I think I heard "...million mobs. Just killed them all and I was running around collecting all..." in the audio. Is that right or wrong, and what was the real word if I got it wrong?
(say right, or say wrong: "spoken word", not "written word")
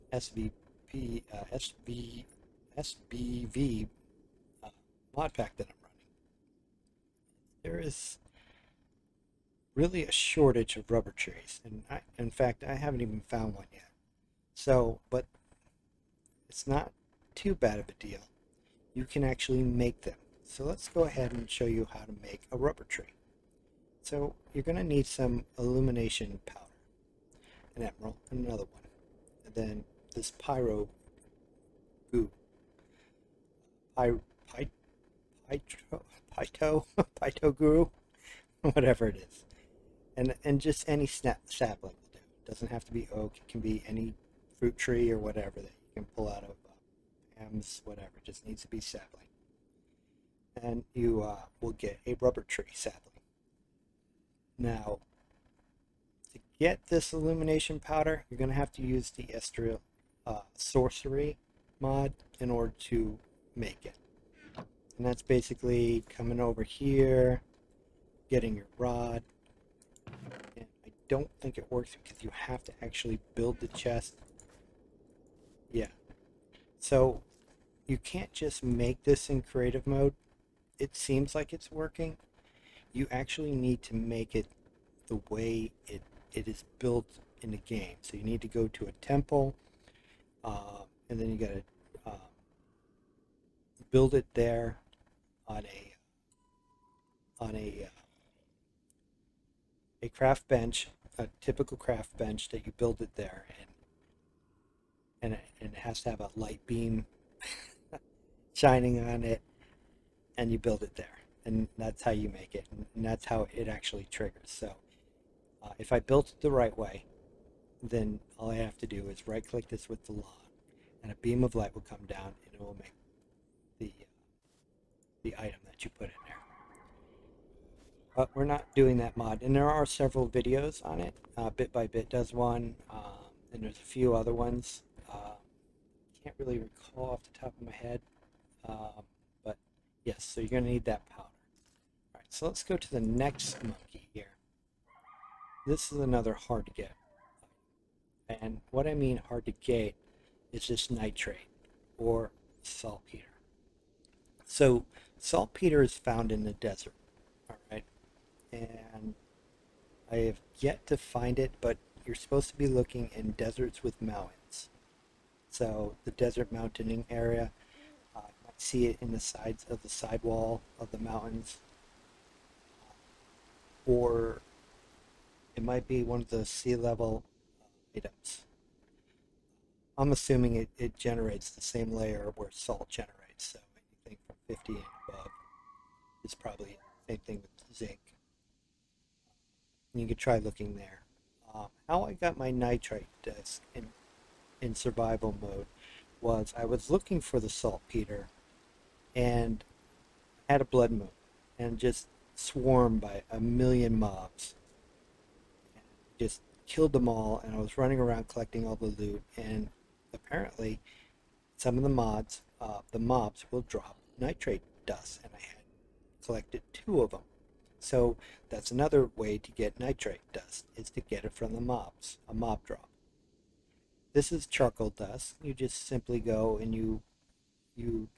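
right.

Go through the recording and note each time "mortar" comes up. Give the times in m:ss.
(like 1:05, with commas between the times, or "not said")
not said.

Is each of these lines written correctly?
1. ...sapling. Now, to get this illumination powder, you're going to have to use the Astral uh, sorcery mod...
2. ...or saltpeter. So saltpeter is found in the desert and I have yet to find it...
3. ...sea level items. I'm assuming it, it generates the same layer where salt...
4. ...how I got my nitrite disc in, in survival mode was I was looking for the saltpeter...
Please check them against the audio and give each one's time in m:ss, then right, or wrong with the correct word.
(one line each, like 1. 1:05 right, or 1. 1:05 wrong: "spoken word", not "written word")
1. 0:52 right
2. 2:31 right
3. 2:56 right
4. 3:11 right.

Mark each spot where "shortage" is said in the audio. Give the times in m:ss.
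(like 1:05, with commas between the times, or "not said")
0:10.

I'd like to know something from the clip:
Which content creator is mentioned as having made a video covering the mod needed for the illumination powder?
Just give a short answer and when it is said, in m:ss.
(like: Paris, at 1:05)
Bit by Bit, at 2:11.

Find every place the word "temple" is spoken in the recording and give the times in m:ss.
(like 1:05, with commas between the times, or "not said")
1:28.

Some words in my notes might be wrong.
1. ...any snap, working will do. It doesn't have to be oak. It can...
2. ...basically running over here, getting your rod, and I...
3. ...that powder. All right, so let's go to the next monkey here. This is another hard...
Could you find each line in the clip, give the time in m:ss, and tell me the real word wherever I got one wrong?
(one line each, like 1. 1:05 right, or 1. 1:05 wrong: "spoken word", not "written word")
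1. 0:40 wrong: "sapling", not "working"
2. 1:05 wrong: "coming", not "running"
3. 2:20 right.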